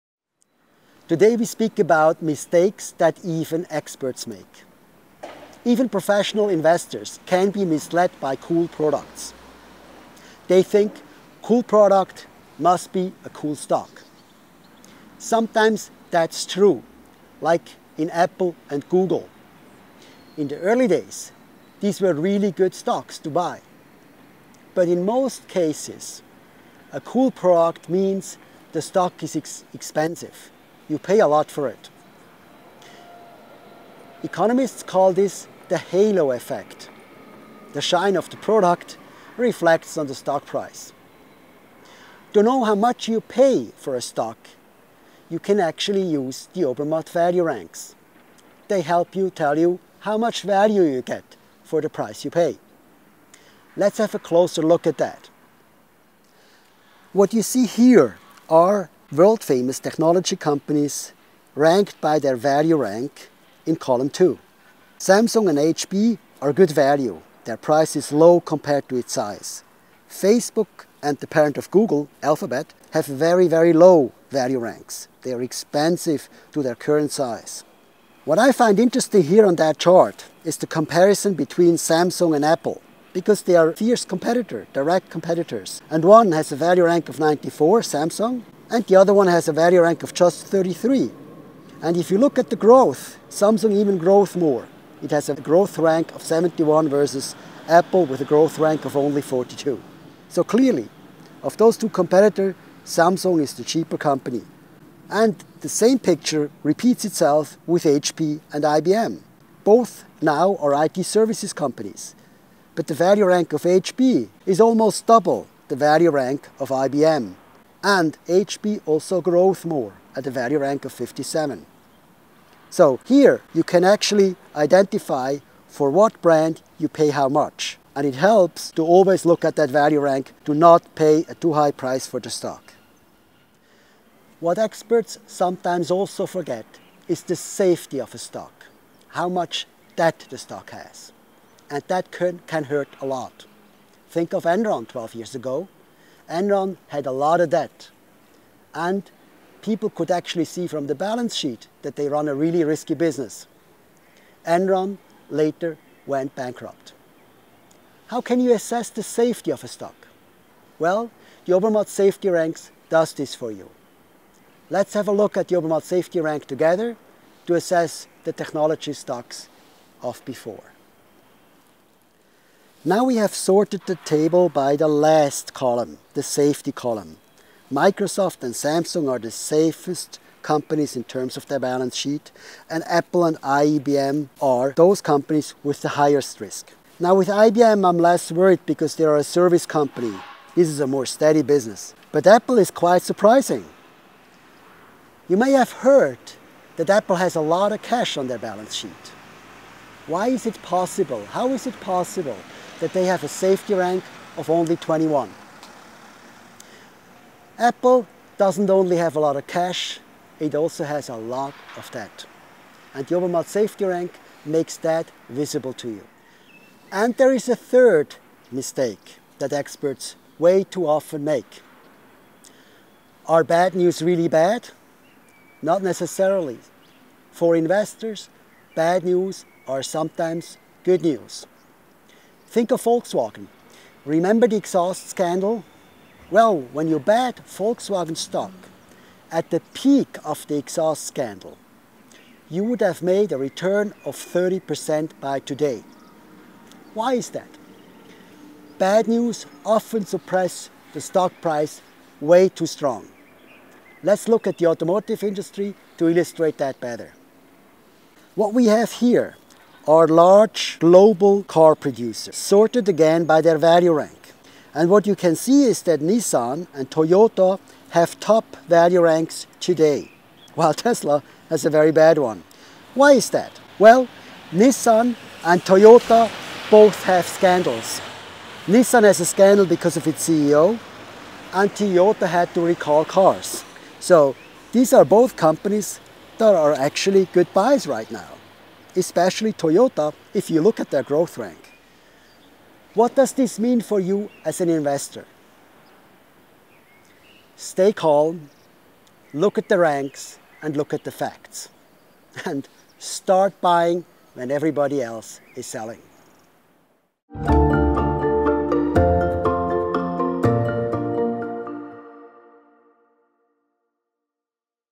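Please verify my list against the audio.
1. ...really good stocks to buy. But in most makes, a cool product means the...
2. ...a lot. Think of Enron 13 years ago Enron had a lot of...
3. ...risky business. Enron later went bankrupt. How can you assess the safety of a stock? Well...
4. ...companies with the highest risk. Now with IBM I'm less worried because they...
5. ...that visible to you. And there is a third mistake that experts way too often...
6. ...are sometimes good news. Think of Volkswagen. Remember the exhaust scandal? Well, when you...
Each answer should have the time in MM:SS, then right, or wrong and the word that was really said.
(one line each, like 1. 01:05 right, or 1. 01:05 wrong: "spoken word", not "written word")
1. 00:22 wrong: "cases", not "makes"
2. 02:23 wrong: "12", not "13"
3. 02:32 right
4. 03:04 right
5. 03:34 right
6. 03:49 right.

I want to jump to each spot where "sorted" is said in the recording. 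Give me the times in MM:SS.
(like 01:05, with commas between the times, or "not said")
02:53, 04:22.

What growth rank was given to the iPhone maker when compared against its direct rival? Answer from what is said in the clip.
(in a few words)
42.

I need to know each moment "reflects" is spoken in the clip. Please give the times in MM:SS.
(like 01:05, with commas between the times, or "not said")
00:39.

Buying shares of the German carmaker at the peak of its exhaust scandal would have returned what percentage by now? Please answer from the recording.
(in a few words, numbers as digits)
30%.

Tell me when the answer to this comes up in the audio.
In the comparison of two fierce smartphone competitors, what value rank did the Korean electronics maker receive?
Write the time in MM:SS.
01:27.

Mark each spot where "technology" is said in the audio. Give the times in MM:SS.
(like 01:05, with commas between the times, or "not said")
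00:59, 02:48.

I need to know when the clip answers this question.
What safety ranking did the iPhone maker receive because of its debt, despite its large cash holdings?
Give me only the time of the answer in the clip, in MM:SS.
03:24.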